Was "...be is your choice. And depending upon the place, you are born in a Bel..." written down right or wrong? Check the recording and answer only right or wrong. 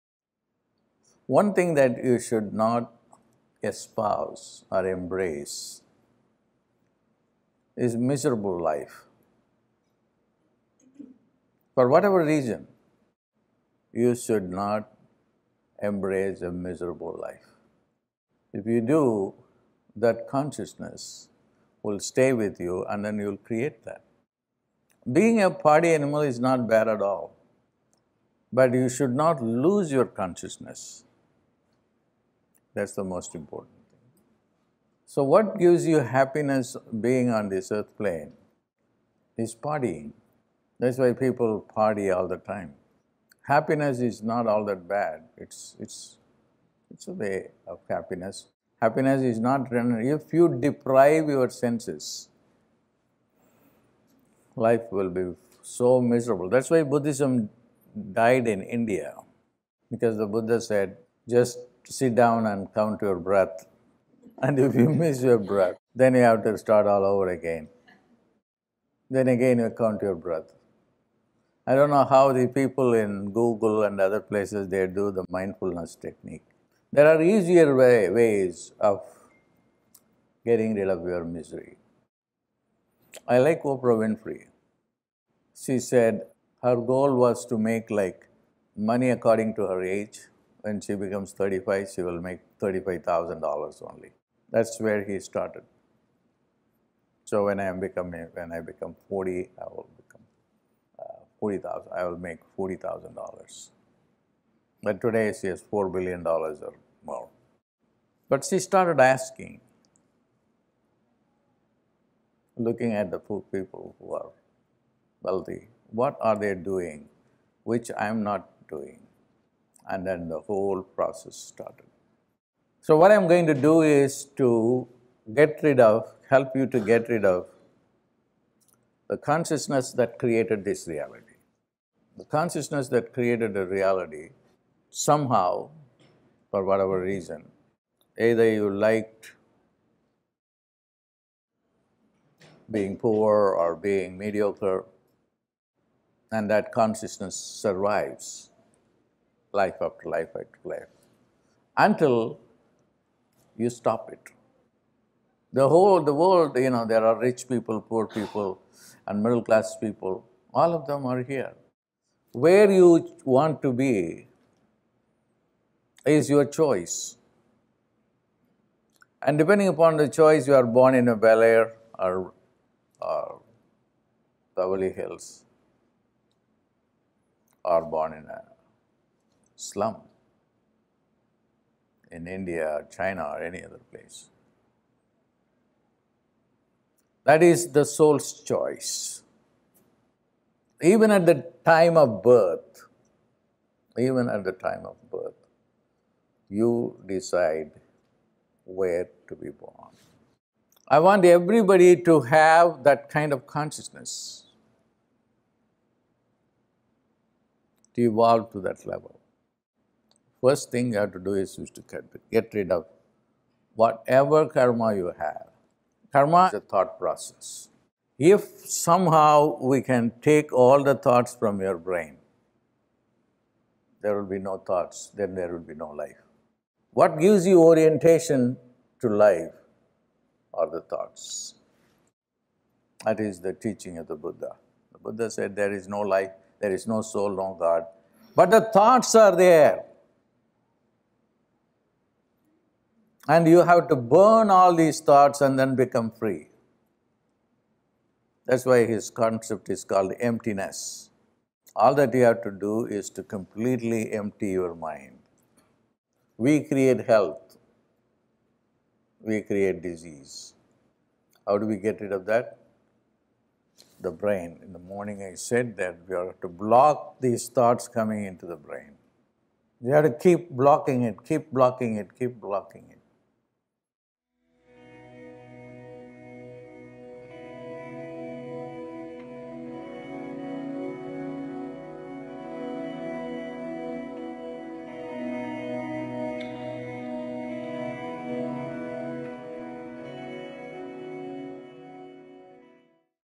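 wrong.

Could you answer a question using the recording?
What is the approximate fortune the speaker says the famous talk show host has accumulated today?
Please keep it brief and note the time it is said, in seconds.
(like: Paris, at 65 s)
$4 billion, at 105 s.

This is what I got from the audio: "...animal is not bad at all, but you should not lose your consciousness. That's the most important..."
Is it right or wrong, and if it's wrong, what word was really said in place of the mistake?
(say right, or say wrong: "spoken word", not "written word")
right.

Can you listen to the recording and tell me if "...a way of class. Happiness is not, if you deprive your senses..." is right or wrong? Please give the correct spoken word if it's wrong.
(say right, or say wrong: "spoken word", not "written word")
wrong: "happiness", not "class".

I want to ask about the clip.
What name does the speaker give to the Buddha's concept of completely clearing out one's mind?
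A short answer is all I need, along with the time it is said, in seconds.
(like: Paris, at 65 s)
emptiness, at 250 s.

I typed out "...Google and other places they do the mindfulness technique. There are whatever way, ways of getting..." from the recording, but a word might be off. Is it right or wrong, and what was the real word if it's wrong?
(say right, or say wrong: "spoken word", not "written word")
wrong: "easier", not "whatever".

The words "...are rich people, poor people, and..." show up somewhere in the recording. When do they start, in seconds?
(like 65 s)
157 s.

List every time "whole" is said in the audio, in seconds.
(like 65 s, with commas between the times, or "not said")
120 s, 155 s.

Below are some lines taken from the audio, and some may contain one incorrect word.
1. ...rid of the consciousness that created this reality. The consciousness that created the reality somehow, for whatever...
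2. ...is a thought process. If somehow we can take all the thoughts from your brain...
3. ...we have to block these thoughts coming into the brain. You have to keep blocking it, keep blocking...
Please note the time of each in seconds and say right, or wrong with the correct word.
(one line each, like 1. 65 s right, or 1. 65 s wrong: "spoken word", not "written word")
1. 127 s right
2. 216 s right
3. 266 s right.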